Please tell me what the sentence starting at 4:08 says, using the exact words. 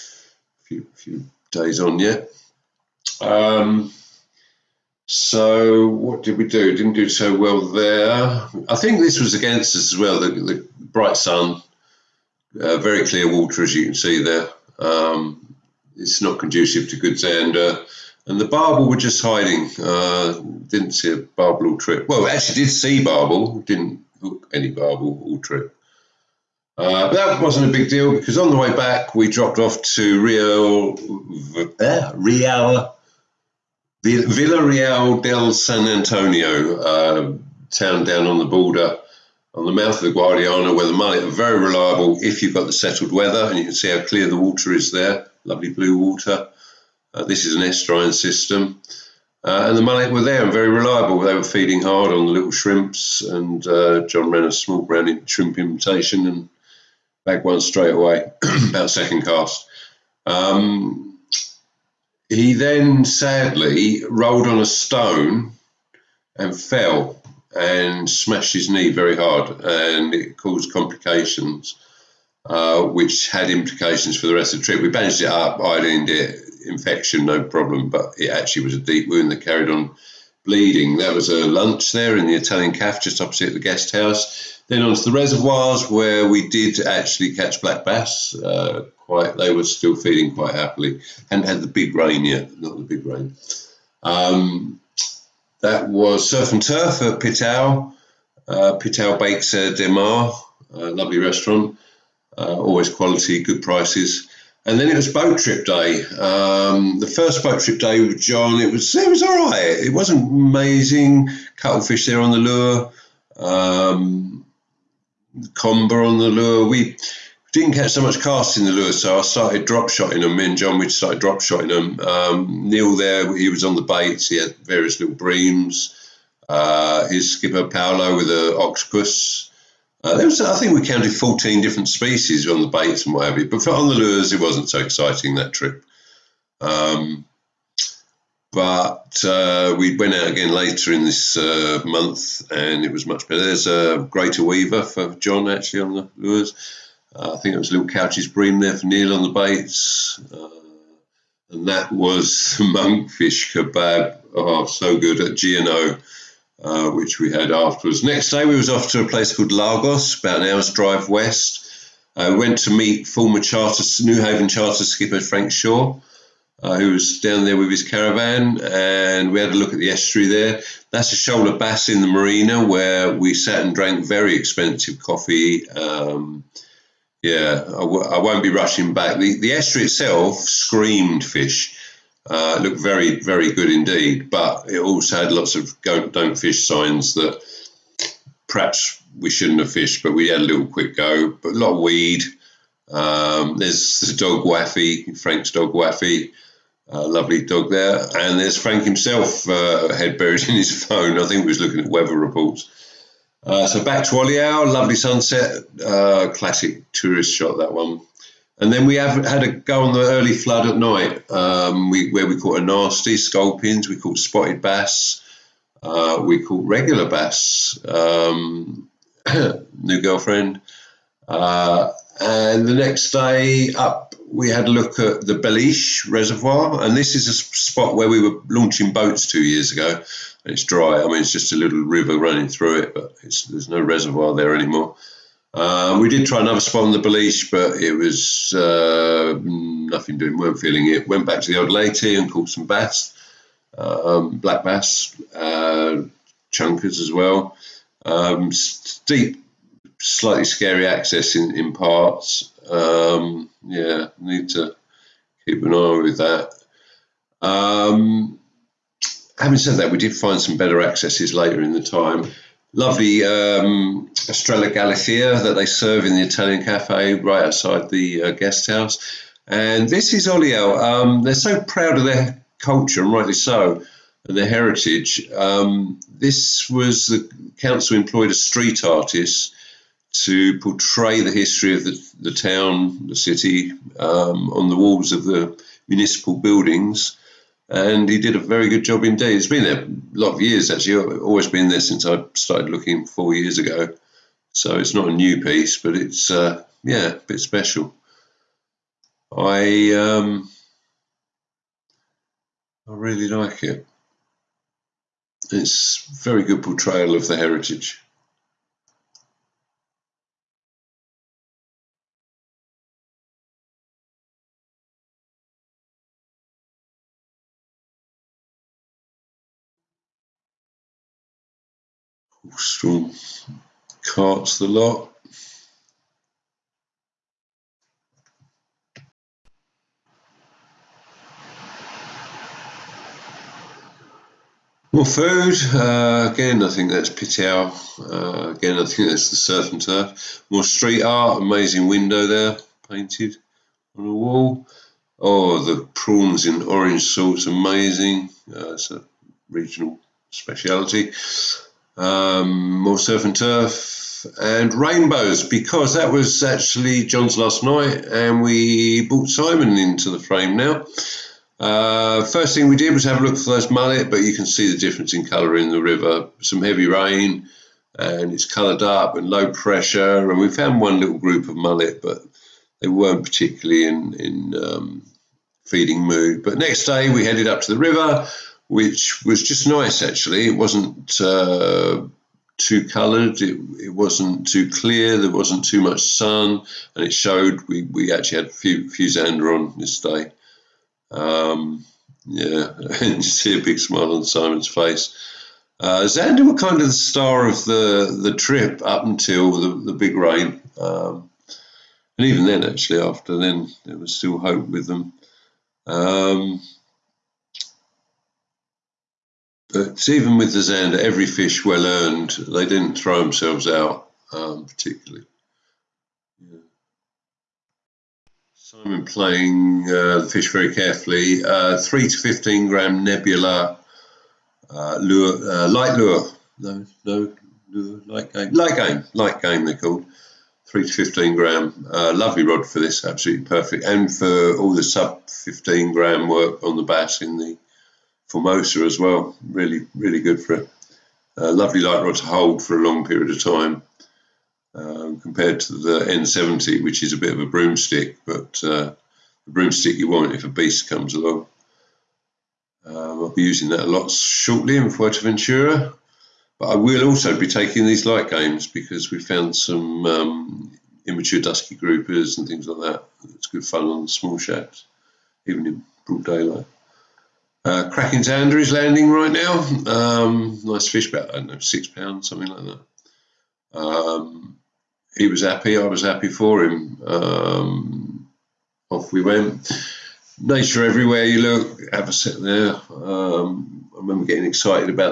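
Um, steep, slightly scary access in, in parts.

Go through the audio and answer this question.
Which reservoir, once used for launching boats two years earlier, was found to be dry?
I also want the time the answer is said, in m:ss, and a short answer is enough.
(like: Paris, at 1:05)
Beliche Reservoir, at 3:45.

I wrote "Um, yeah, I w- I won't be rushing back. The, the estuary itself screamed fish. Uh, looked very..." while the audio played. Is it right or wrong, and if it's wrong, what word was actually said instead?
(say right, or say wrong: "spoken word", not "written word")
right.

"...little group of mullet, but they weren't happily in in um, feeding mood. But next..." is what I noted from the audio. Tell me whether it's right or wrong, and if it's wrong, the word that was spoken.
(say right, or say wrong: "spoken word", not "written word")
wrong: "particularly", not "happily".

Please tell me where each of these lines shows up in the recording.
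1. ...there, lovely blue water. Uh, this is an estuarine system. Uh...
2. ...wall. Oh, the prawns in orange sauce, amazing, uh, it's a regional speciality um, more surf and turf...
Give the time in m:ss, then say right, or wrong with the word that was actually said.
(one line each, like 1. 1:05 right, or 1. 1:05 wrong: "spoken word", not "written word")
1. 0:44 right
2. 5:44 right.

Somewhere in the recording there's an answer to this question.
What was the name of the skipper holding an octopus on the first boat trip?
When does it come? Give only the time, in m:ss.
2:07.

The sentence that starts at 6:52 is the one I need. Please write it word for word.
They didn't throw themselves out um, particularly.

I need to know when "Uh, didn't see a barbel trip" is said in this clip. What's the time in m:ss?
0:19.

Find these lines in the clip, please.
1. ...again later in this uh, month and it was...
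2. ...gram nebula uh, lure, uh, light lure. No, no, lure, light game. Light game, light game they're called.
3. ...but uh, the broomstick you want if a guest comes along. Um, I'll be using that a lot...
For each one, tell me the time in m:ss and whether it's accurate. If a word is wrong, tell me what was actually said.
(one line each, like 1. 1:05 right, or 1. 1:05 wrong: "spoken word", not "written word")
1. 2:20 right
2. 7:02 right
3. 7:28 wrong: "beast", not "guest".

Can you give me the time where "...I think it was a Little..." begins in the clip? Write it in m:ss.
2:27.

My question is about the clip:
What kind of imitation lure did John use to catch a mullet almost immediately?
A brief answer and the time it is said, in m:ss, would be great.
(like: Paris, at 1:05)
Small brown shrimp, at 0:54.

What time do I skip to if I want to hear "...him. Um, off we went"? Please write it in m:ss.
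7:56.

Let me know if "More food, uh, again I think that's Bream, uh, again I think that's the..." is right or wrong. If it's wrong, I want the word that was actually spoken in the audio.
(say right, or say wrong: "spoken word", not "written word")
wrong: "Pitel", not "Bream".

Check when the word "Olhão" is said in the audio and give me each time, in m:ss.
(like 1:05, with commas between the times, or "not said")
3:24, 4:30.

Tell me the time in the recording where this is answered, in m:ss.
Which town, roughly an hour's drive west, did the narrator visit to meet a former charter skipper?
2:39.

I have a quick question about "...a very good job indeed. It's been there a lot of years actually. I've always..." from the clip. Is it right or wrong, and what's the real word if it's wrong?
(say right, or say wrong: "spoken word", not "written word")
right.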